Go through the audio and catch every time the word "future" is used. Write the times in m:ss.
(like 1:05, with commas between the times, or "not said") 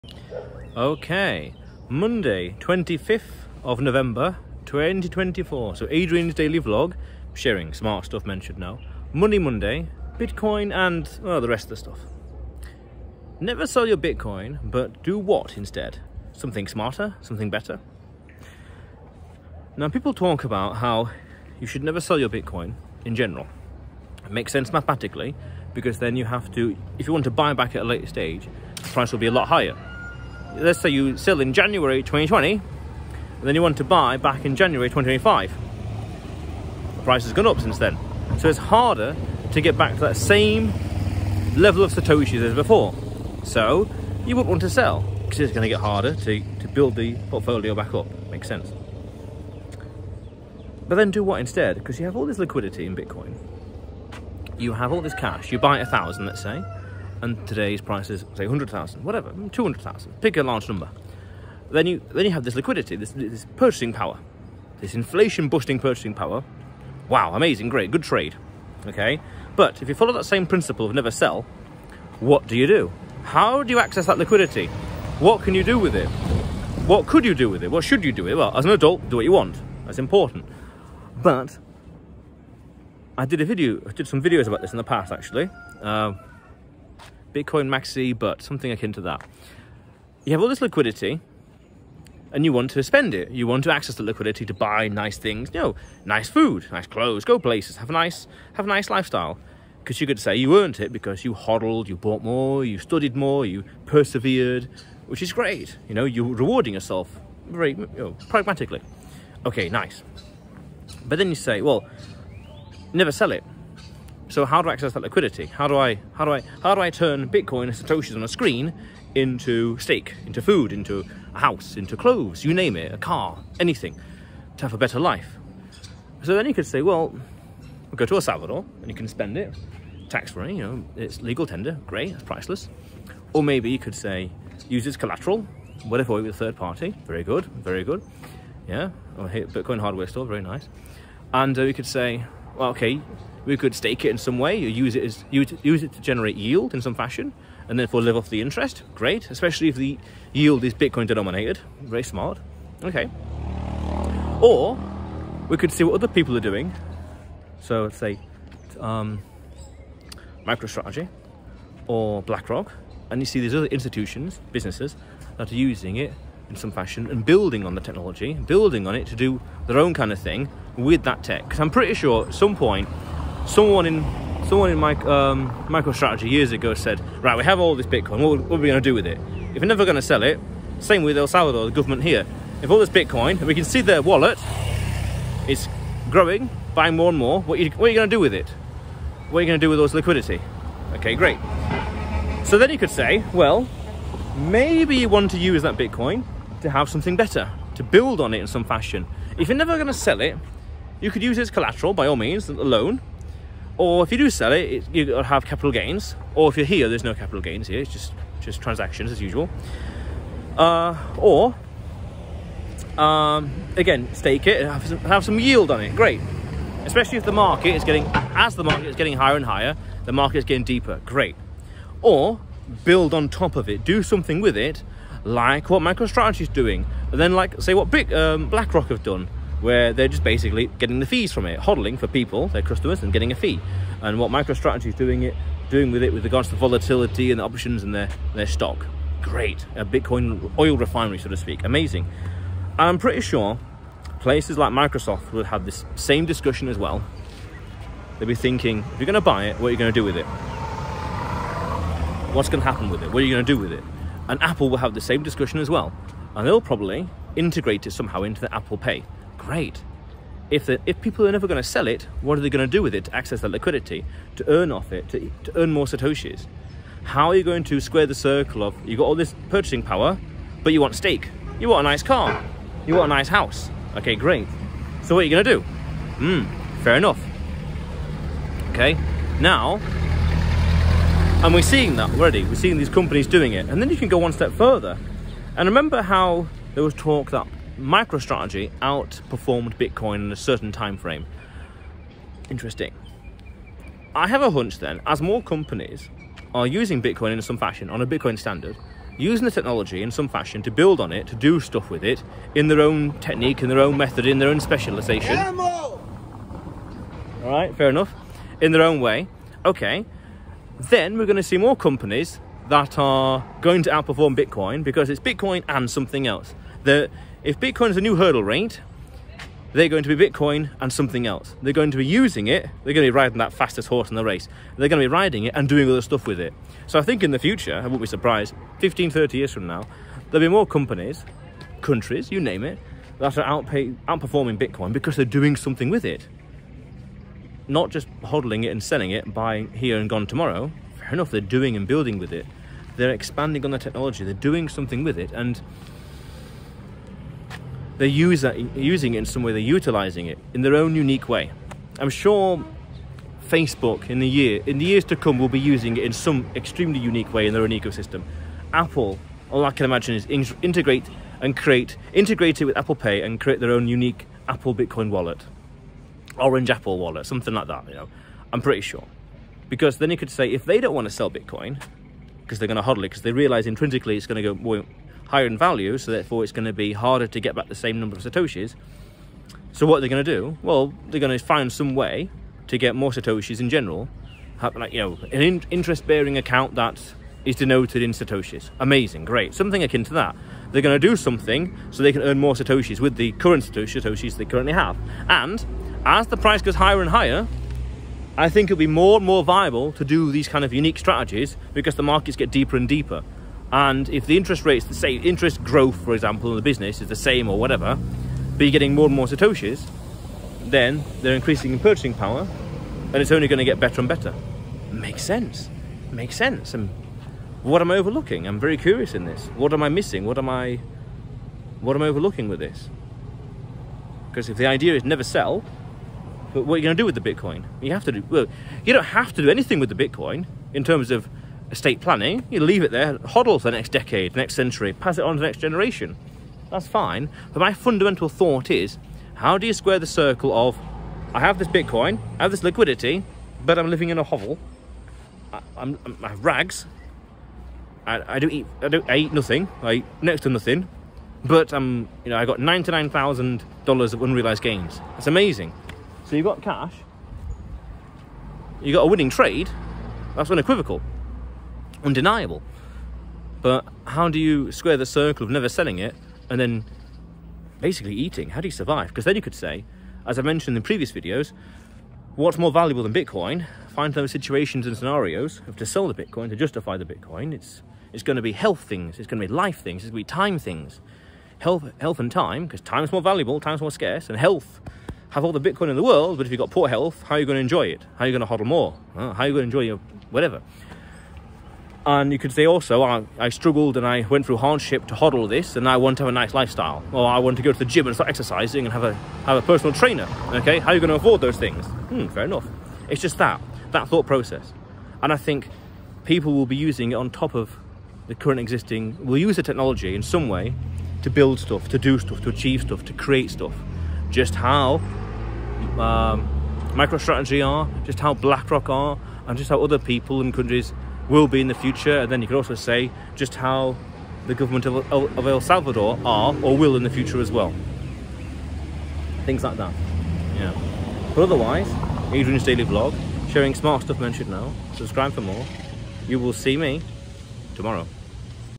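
5:27, 8:41, 8:47.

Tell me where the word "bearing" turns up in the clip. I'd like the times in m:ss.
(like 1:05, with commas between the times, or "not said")
6:25.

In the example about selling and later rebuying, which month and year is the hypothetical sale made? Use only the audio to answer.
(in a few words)
January 2020.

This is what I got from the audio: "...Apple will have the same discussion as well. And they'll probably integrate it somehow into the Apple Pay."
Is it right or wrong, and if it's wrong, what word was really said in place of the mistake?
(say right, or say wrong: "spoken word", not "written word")
right.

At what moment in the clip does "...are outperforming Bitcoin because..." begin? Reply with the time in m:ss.
5:33.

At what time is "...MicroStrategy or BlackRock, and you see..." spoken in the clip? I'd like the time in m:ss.
2:40.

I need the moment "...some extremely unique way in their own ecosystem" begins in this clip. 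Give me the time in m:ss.
5:56.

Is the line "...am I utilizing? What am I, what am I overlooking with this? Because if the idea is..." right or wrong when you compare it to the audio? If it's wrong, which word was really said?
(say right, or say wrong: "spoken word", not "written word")
wrong: "missing", not "utilizing".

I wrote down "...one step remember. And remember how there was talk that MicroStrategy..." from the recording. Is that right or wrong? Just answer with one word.
wrong.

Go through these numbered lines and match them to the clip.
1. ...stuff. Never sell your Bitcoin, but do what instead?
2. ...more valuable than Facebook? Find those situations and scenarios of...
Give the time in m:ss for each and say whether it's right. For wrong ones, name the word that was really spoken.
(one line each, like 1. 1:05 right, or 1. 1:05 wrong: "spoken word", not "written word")
1. 0:11 right
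2. 7:52 wrong: "Bitcoin", not "Facebook".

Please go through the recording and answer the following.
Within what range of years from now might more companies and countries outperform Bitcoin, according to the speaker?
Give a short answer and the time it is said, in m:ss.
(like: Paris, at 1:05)
15 to 30 years, at 5:28.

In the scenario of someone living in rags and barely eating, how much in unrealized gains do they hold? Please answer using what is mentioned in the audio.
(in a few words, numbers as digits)
$99,000.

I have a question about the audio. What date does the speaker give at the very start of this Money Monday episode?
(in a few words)
25th of November, 2024.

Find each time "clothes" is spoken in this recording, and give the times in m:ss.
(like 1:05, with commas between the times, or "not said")
1:36, 2:01.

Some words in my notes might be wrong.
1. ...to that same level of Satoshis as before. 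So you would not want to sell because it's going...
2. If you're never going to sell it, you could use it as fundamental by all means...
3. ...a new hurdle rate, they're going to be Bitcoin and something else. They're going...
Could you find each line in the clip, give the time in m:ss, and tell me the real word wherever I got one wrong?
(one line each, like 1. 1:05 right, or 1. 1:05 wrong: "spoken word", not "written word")
1. 0:39 right
2. 3:19 wrong: "collateral", not "fundamental"
3. 5:17 right.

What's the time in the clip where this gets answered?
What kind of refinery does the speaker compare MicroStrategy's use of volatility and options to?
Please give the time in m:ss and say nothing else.
3:59.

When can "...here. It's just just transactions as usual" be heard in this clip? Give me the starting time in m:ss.
3:27.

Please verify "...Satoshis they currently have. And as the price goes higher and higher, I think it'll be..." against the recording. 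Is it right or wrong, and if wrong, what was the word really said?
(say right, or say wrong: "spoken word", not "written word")
right.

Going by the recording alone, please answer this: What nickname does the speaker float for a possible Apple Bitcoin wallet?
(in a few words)
Orange Apple wallet.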